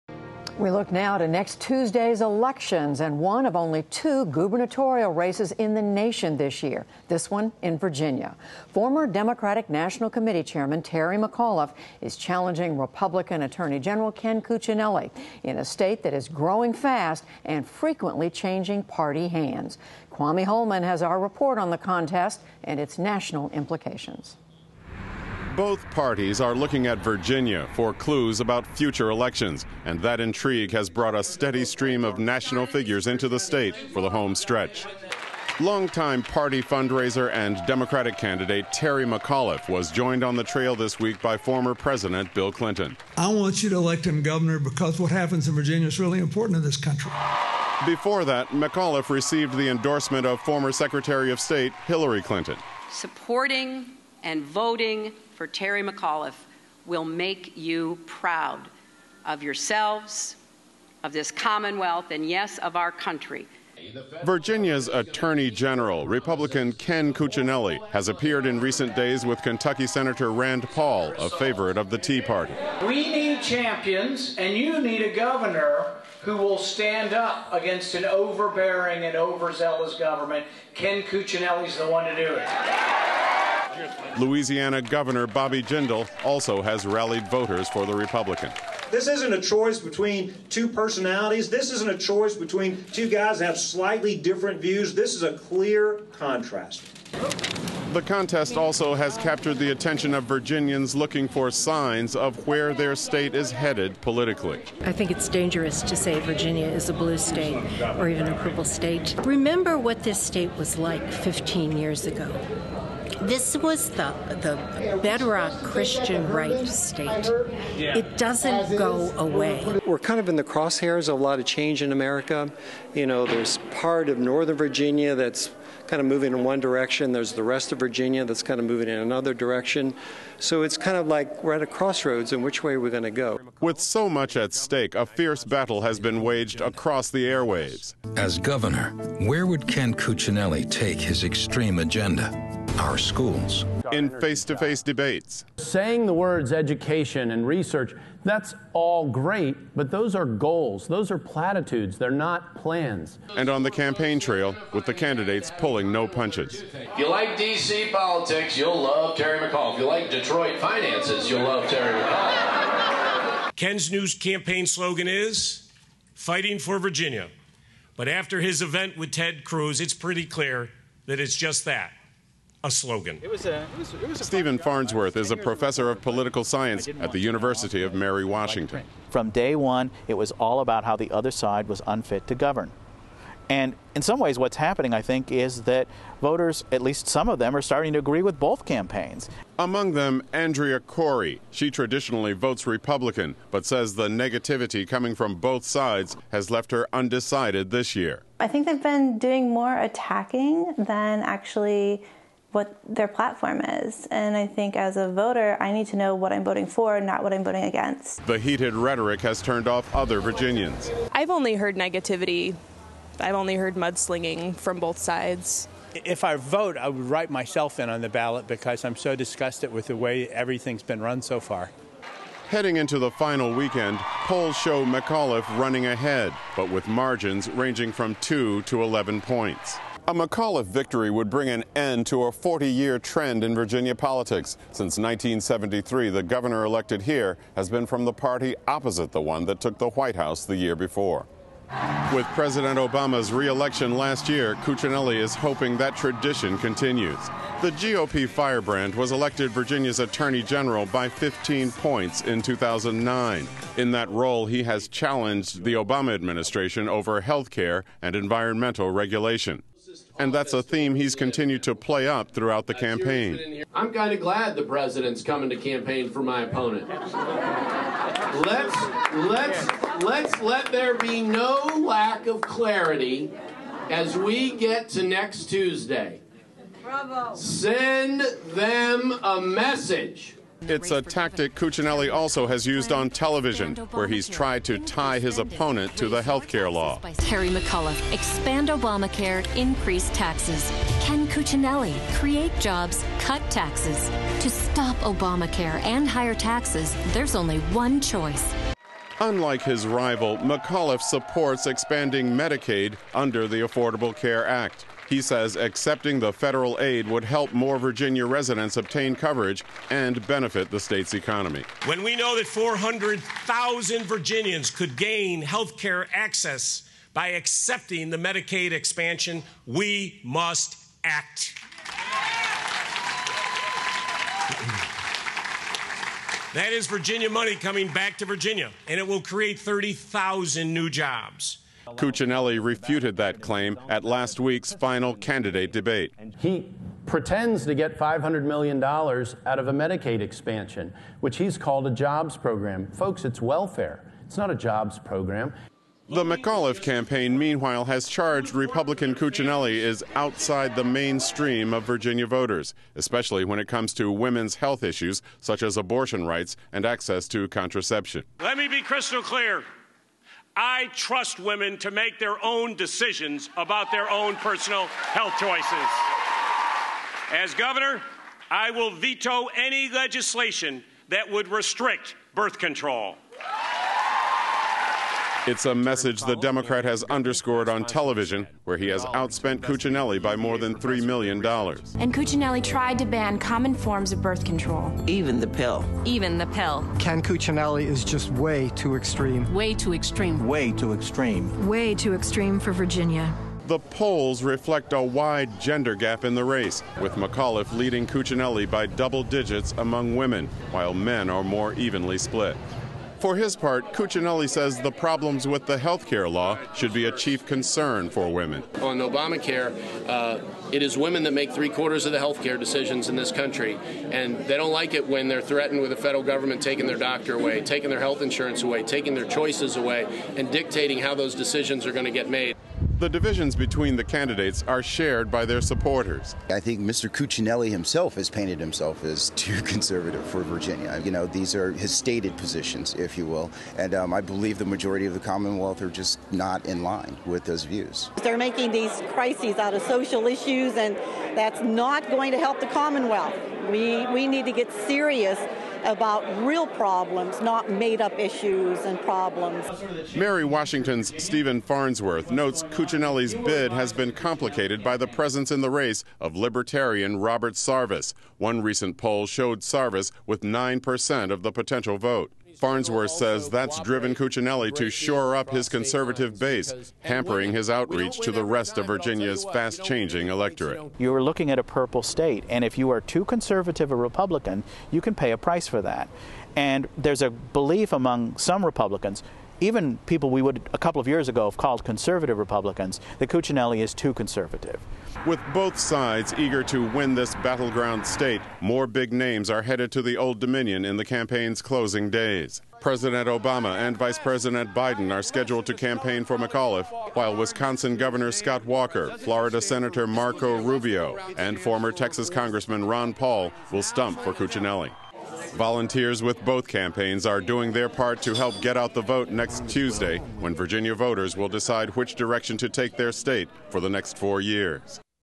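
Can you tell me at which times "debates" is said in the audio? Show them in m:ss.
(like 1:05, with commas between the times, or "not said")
2:24, 5:35.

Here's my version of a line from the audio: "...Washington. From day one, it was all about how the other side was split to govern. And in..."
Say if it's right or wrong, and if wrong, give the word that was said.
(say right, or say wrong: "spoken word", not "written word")
wrong: "unfit", not "split".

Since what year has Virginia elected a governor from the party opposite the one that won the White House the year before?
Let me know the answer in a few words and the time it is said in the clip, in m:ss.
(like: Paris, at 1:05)
1973, at 3:54.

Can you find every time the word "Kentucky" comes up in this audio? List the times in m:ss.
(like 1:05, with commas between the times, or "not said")
1:09.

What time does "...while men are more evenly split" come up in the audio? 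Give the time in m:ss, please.
6:40.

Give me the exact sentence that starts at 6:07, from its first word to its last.
As governor, I will veto any legislation that would restrict birth control.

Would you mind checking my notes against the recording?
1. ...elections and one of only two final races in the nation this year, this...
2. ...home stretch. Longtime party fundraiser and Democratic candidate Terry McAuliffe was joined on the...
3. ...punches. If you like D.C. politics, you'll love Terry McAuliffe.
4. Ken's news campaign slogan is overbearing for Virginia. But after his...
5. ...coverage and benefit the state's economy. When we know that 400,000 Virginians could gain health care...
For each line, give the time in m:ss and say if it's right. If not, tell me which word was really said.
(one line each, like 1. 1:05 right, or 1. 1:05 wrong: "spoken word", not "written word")
1. 0:02 wrong: "gubernatorial", not "final"
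2. 0:34 right
3. 2:36 right
4. 2:43 wrong: "fighting", not "overbearing"
5. 5:09 right.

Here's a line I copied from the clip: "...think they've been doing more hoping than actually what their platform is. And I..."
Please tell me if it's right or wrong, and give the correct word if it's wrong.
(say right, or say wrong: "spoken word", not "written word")
wrong: "attacking", not "hoping".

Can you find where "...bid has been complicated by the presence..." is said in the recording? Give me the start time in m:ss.
7:33.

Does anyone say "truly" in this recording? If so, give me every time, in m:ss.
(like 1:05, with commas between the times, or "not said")
not said.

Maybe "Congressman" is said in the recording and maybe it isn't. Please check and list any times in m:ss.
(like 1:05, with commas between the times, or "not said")
8:22.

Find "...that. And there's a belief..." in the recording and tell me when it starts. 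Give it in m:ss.
7:55.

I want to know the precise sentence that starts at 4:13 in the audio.
In that role, he has challenged the Obama administration over health care and environmental regulation.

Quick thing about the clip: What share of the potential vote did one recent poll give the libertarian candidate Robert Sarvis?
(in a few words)
9%.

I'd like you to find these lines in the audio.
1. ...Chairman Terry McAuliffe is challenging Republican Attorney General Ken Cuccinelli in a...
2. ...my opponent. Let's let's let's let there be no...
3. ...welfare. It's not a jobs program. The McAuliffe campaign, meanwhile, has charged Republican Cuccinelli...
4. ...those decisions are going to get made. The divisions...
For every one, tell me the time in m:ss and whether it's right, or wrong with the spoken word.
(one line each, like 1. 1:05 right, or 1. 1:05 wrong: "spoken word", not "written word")
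1. 0:10 right
2. 4:26 right
3. 5:43 right
4. 7:01 right.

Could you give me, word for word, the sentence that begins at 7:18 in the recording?
They're making these crises out of social issues, and that's not going to help the Commonwealth.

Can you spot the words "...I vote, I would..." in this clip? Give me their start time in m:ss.
3:36.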